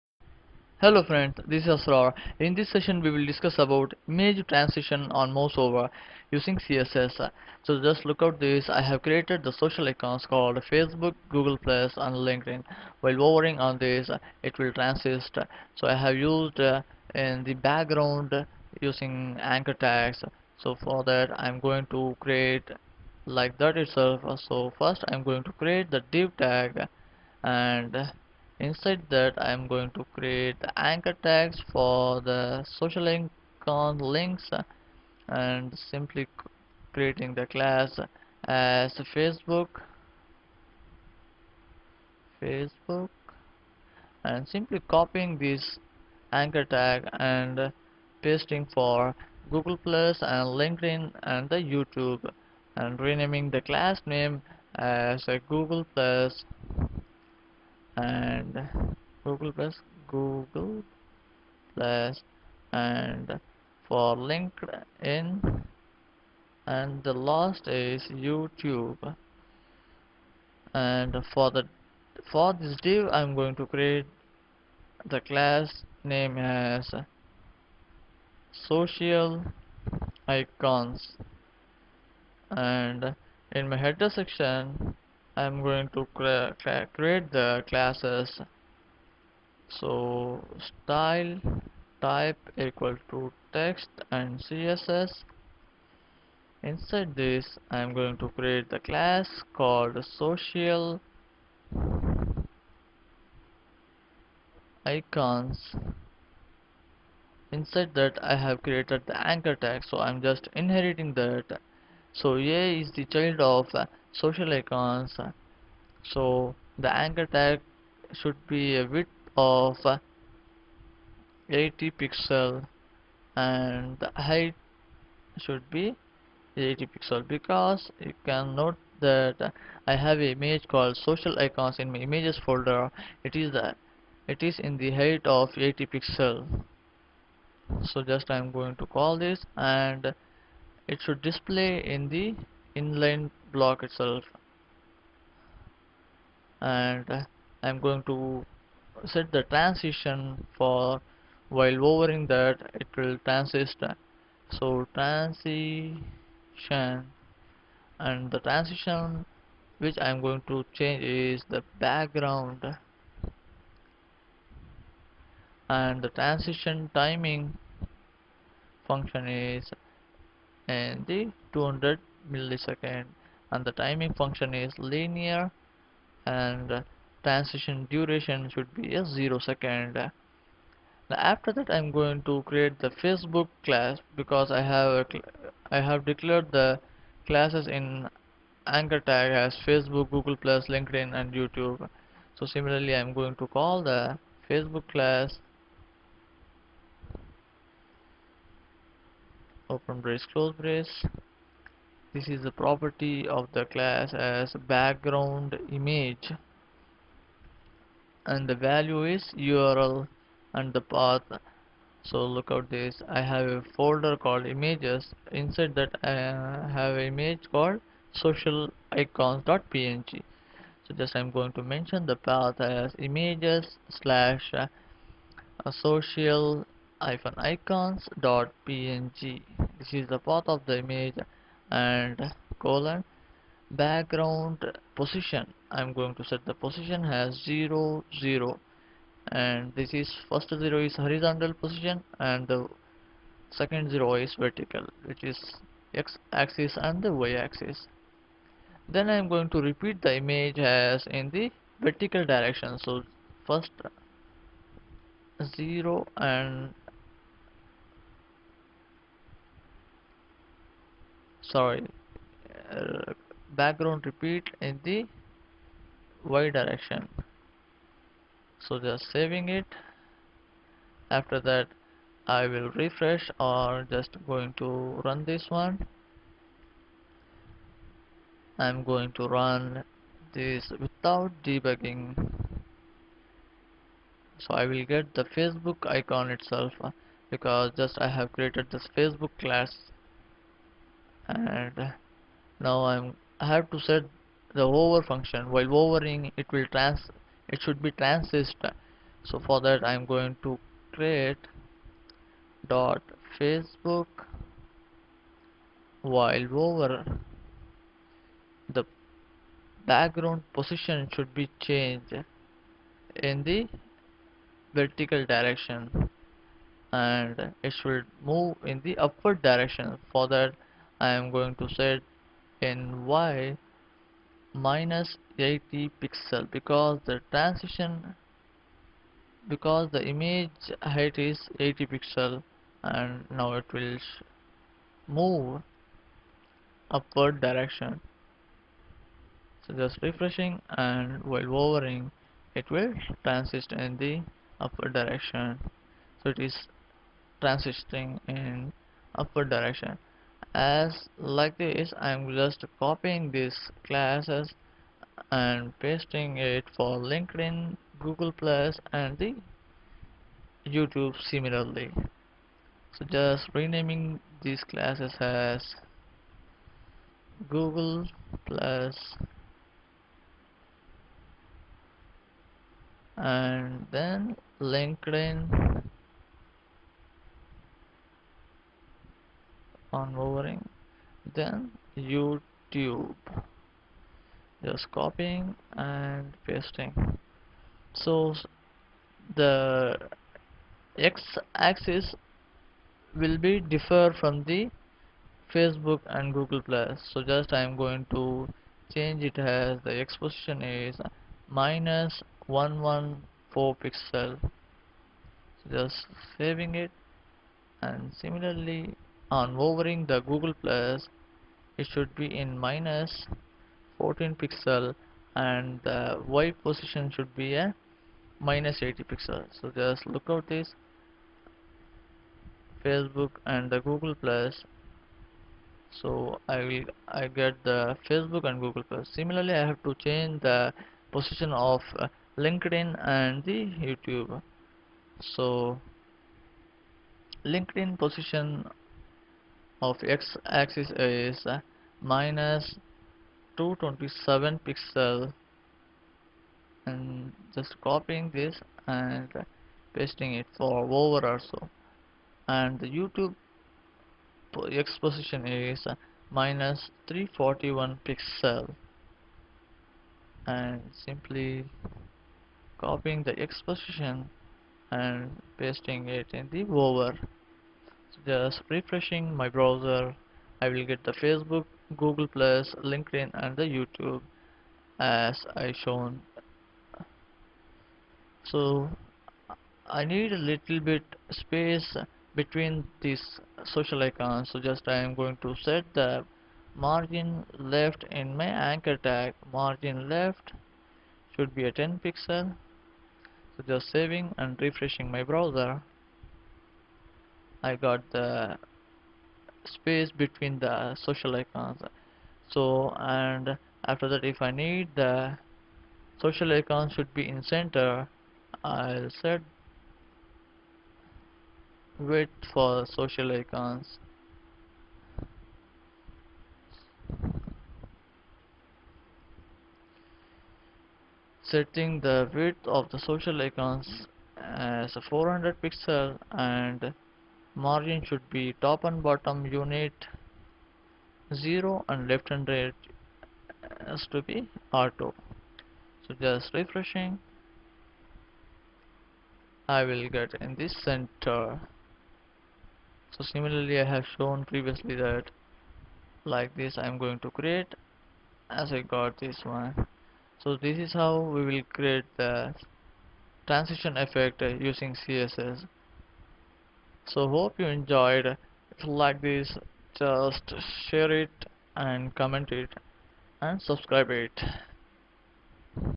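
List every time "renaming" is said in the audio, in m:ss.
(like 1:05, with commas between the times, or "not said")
0:52, 6:03.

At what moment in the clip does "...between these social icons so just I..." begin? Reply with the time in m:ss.
8:02.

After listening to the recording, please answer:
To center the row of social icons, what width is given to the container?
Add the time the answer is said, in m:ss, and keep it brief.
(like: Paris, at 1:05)
400 pixels, at 8:45.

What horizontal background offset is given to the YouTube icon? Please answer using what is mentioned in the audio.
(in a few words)
-341 pixels.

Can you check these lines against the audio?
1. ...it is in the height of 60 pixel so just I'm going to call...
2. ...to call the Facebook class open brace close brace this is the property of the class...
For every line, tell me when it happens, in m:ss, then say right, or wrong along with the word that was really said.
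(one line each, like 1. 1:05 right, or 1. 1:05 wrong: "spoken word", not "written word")
1. 2:14 wrong: "80", not "60"
2. 3:13 right.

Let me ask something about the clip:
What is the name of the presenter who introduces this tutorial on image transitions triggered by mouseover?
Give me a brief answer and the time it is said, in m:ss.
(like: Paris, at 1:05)
Asraar, at 0:01.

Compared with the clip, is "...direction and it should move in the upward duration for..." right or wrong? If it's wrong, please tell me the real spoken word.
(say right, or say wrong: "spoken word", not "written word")
wrong: "direction", not "duration".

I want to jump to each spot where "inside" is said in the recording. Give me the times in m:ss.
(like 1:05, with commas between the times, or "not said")
0:28, 1:36, 1:47, 3:35.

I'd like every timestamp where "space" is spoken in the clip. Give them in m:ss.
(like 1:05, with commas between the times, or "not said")
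8:01, 8:19.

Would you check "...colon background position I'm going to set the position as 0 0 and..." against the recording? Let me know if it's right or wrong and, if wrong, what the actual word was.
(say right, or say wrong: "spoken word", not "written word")
right.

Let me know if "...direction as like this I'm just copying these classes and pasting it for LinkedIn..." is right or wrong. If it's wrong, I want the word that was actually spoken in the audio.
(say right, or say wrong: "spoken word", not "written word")
right.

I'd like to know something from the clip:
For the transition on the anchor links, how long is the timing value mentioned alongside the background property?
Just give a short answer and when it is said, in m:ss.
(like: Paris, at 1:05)
200 milliseconds, at 2:51.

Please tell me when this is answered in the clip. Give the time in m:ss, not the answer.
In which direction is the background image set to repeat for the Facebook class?
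4:26.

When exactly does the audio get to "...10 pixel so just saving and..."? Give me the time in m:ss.
8:11.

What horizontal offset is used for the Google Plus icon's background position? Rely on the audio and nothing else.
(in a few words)
-114 pixels.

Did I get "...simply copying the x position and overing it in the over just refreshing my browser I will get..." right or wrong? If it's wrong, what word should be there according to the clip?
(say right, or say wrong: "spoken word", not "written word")
wrong: "pasting", not "overing".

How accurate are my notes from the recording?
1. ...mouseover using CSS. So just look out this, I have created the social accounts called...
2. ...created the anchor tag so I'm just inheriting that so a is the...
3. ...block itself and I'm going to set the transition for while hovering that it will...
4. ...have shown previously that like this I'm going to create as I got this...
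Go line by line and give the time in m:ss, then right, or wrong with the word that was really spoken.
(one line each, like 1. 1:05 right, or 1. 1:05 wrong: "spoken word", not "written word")
1. 0:05 right
2. 1:48 right
3. 2:23 right
4. 9:03 right.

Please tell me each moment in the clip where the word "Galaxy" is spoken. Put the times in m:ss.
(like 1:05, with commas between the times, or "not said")
not said.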